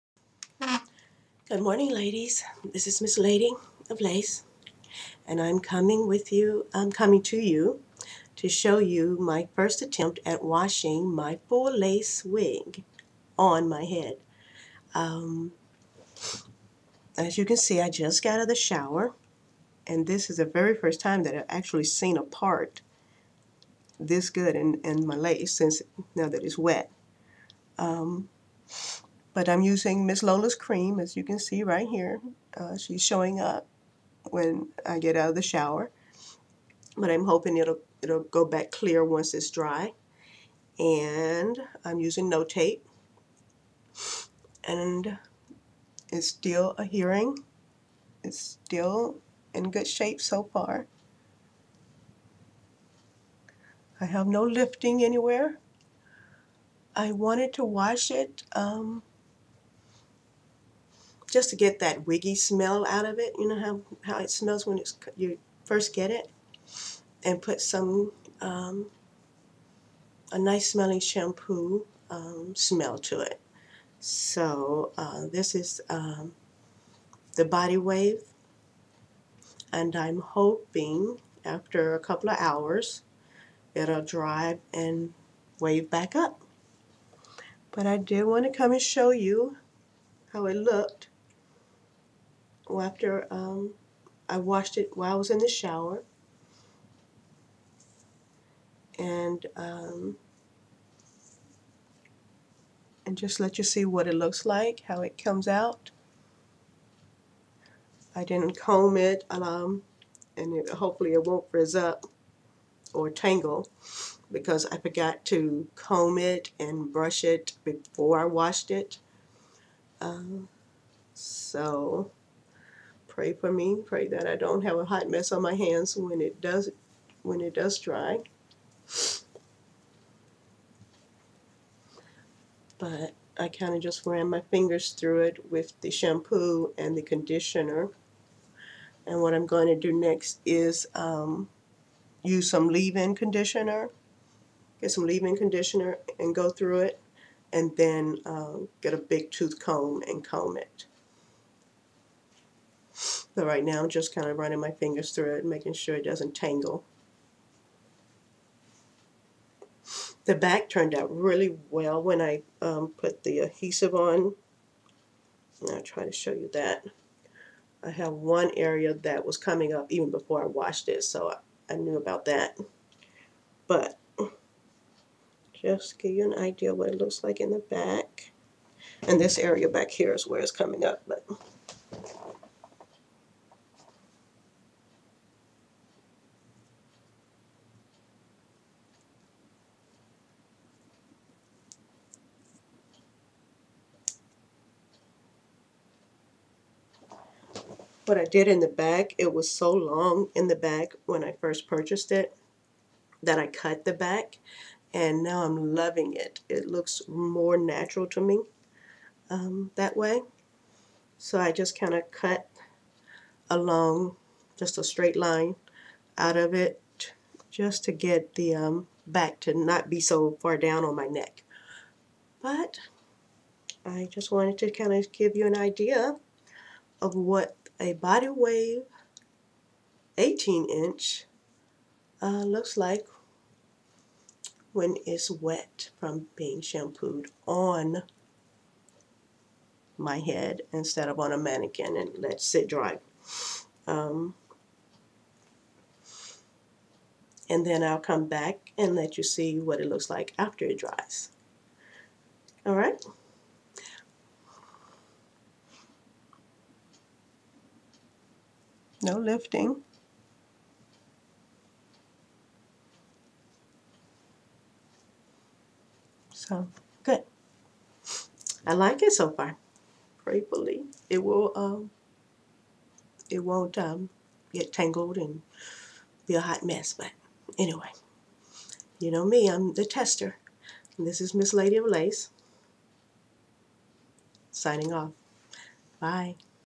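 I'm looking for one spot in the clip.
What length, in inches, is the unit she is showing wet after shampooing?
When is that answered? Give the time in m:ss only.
3:50.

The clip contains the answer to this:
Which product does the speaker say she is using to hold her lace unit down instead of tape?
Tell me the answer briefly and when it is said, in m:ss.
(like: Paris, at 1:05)
Miss Lola's cream, at 0:30.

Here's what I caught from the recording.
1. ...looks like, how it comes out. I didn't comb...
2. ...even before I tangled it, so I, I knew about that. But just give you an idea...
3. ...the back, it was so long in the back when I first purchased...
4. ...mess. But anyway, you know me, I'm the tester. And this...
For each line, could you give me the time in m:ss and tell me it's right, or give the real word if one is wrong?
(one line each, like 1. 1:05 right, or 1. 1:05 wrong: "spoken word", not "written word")
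1. 1:44 right
2. 2:49 wrong: "washed", not "tangled"
3. 3:18 right
4. 4:36 right.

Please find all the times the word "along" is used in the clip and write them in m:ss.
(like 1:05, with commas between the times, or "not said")
3:33.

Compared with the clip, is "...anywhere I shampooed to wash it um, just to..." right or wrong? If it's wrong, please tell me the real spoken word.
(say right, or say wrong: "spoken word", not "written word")
wrong: "wanted", not "shampooed".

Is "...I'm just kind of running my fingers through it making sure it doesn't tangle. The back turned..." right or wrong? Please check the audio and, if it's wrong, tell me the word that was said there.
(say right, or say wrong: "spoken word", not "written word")
right.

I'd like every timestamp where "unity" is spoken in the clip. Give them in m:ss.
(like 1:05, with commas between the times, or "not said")
not said.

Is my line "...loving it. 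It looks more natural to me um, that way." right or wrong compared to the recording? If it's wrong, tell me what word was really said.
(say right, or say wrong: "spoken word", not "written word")
right.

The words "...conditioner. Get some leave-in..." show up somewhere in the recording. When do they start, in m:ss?
2:23.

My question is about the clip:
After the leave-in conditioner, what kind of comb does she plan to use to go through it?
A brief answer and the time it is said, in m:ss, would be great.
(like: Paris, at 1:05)
big tooth comb, at 2:28.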